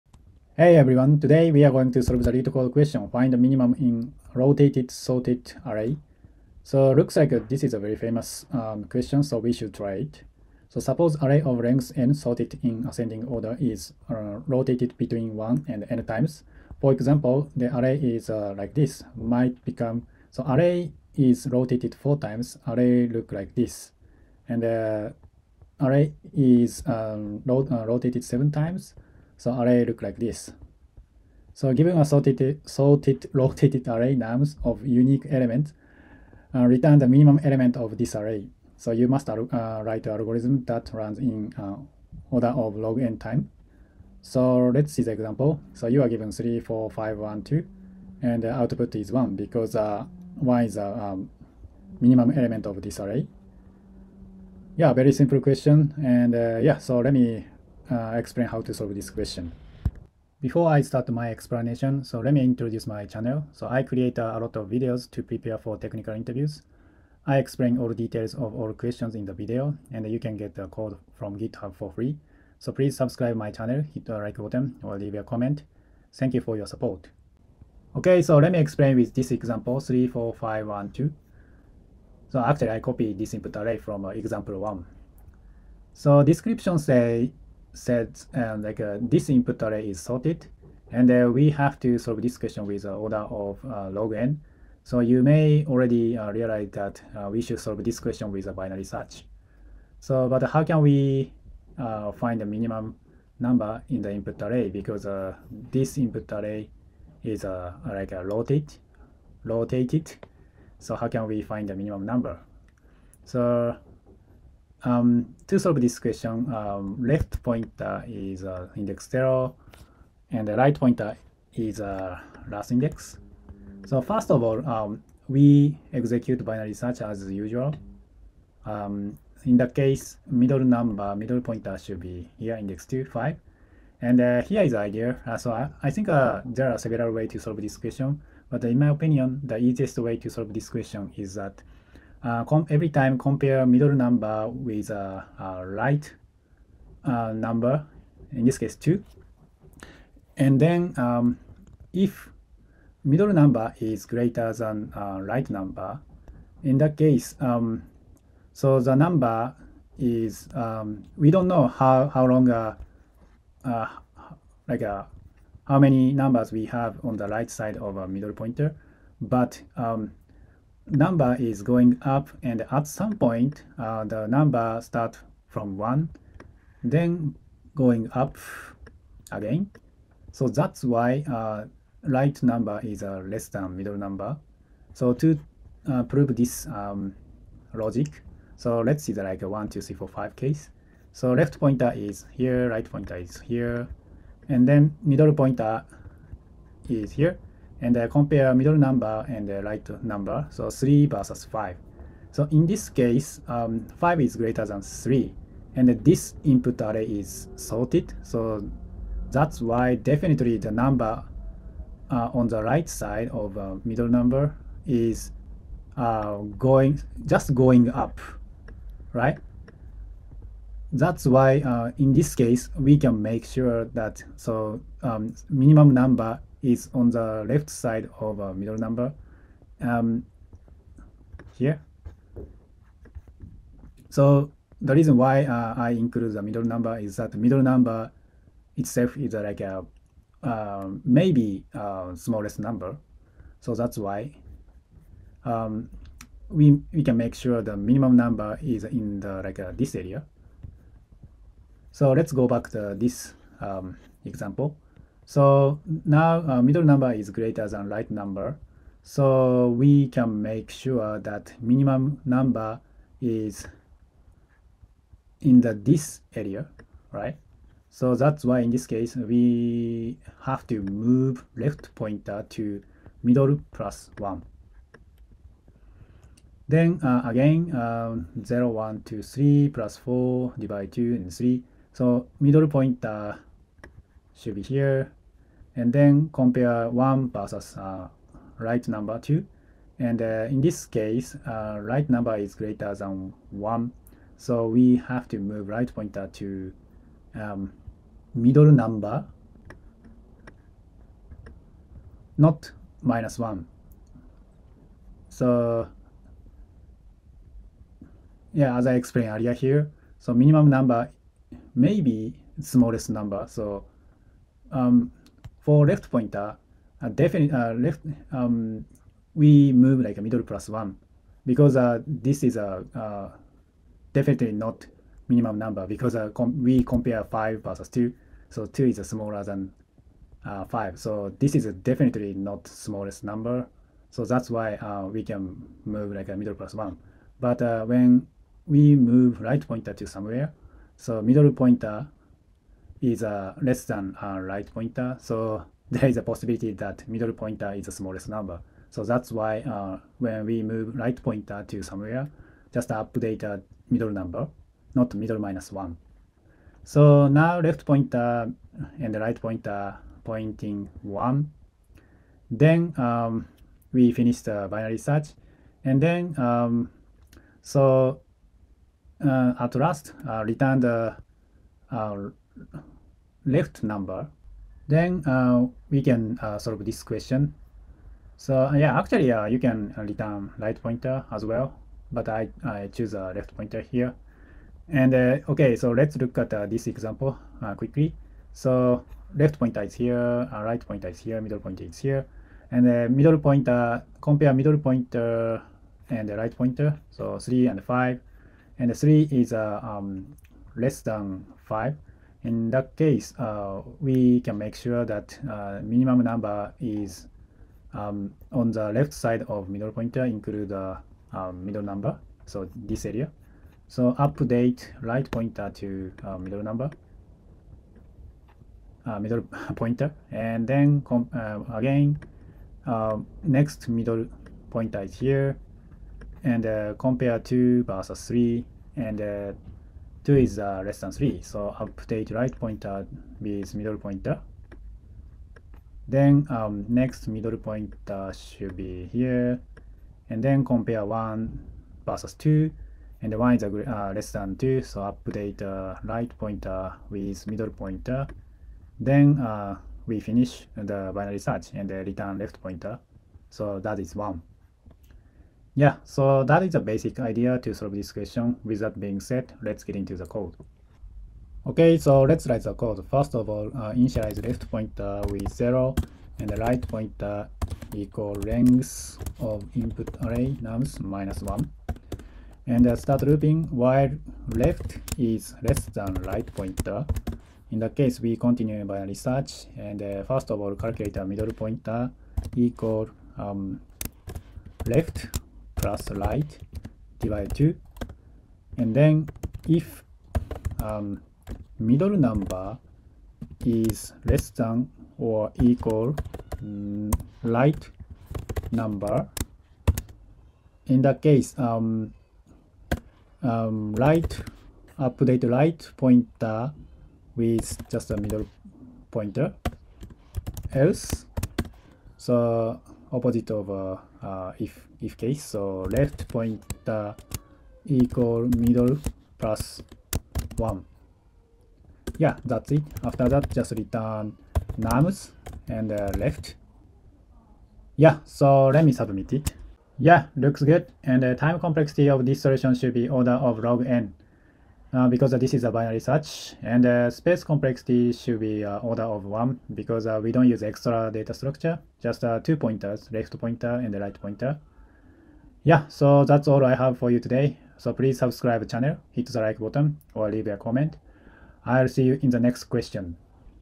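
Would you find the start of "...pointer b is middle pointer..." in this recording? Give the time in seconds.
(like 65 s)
432 s.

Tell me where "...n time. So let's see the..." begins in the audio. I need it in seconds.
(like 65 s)
43 s.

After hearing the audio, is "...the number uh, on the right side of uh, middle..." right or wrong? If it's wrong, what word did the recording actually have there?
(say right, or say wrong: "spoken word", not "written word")
right.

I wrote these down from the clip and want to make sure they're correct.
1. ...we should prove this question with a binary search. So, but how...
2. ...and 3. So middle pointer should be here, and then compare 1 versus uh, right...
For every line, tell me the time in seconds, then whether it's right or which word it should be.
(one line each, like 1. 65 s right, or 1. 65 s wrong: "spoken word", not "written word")
1. 97 s wrong: "solve", not "prove"
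2. 281 s right.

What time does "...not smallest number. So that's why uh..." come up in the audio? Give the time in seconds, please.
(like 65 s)
332 s.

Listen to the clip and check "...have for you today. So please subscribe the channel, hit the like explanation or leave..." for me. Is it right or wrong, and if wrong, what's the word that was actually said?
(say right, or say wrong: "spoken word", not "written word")
wrong: "button", not "explanation".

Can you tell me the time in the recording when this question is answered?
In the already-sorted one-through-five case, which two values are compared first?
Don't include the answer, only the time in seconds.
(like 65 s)
200 s.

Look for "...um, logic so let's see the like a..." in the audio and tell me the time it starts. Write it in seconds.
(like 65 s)
186 s.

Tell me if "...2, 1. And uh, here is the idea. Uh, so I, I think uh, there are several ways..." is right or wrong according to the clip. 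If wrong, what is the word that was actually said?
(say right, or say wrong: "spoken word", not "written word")
wrong: "5", not "1".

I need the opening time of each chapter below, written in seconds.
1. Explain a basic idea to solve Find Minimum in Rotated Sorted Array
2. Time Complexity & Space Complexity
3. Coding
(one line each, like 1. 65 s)
1. 77 s
2. 529 s
3. 461 s.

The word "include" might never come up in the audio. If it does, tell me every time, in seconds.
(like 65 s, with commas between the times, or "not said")
235 s, 410 s.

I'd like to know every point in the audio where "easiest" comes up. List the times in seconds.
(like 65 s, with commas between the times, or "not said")
139 s.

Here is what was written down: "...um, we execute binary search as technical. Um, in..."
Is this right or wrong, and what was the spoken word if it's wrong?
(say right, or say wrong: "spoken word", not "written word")
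wrong: "usual", not "technical".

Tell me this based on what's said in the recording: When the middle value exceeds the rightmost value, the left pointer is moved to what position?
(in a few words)
middle plus 1.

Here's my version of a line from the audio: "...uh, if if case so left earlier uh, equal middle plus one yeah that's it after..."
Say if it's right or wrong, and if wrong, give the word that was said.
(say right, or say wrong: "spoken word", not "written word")
wrong: "pointer", not "earlier".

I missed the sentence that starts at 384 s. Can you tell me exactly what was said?
And okay, so let's look at this example quickly.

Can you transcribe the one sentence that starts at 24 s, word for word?
And uh, array is um, uh, rotated 7 times, so array look like this.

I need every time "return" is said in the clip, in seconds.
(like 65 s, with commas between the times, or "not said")
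36 s, 370 s, 380 s, 451 s, 523 s.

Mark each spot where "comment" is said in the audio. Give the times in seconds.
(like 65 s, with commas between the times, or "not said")
75 s, 550 s.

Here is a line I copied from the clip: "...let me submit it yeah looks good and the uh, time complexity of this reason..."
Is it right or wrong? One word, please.
wrong.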